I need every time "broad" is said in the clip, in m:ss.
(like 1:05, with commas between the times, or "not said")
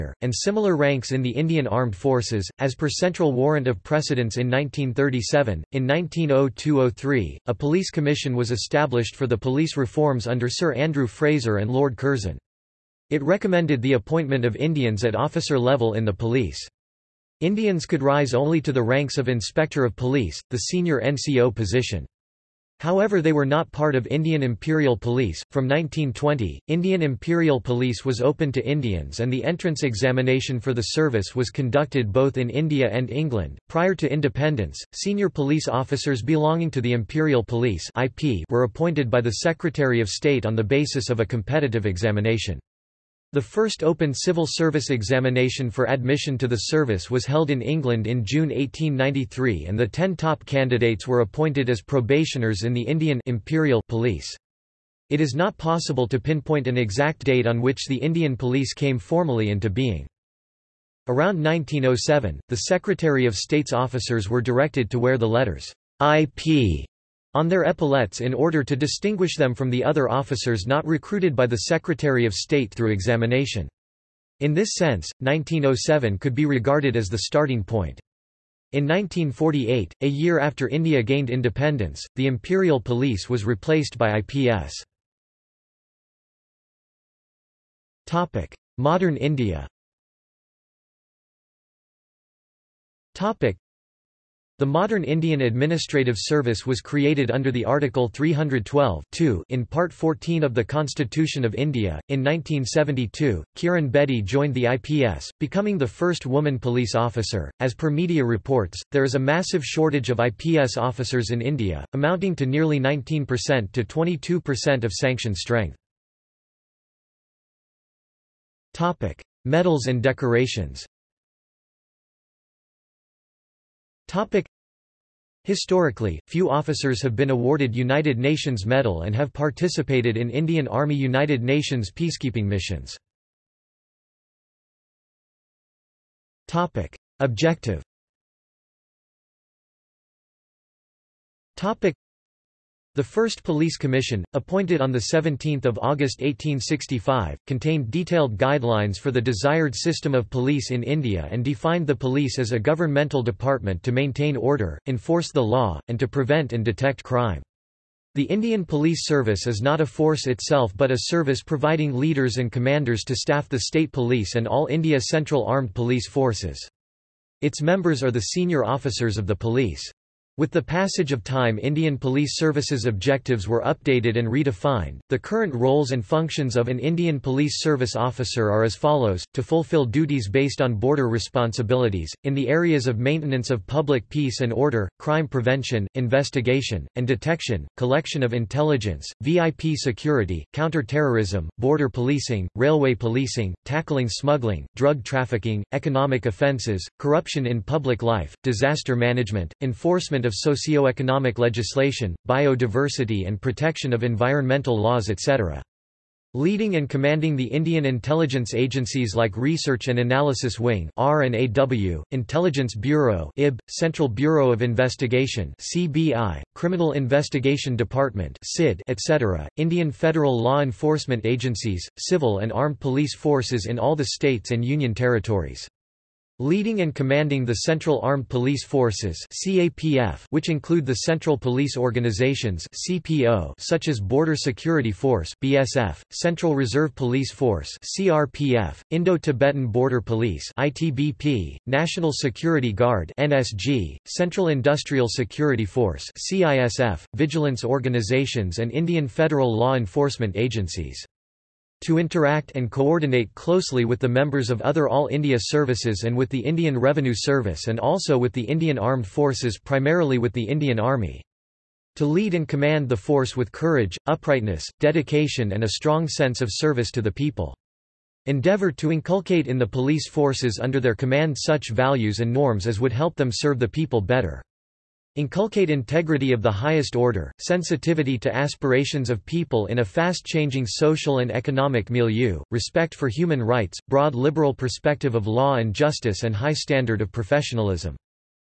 4:43.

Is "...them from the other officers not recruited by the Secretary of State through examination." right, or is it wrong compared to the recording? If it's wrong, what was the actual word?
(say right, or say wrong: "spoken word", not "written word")
right.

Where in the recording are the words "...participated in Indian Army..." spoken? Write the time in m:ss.
2:09.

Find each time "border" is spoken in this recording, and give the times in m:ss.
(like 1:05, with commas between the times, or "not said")
3:00, 3:11, 3:53, 3:59.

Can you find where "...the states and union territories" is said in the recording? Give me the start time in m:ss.
3:43.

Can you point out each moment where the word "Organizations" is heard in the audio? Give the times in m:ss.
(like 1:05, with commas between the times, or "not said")
3:51, 4:07.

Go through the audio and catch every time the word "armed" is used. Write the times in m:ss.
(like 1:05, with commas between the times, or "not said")
0:01, 2:45, 3:42, 3:48, 4:18.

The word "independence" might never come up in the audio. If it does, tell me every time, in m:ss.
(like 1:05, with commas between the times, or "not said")
0:34, 1:21.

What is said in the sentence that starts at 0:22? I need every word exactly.
However, they were not part of Indian Imperial Police.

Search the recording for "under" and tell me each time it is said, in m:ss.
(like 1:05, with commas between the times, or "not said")
0:10, 1:37, 4:30.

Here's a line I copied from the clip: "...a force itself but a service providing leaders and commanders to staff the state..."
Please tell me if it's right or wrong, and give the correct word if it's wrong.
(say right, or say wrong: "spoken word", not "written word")
right.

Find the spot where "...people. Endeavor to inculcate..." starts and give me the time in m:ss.
4:27.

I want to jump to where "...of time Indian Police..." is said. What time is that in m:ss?
2:51.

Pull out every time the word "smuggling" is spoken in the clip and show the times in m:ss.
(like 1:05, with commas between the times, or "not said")
3:14.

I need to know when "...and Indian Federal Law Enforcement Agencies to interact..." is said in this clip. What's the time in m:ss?
4:08.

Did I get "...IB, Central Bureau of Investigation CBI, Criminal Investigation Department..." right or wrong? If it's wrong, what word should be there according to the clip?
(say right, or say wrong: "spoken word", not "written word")
right.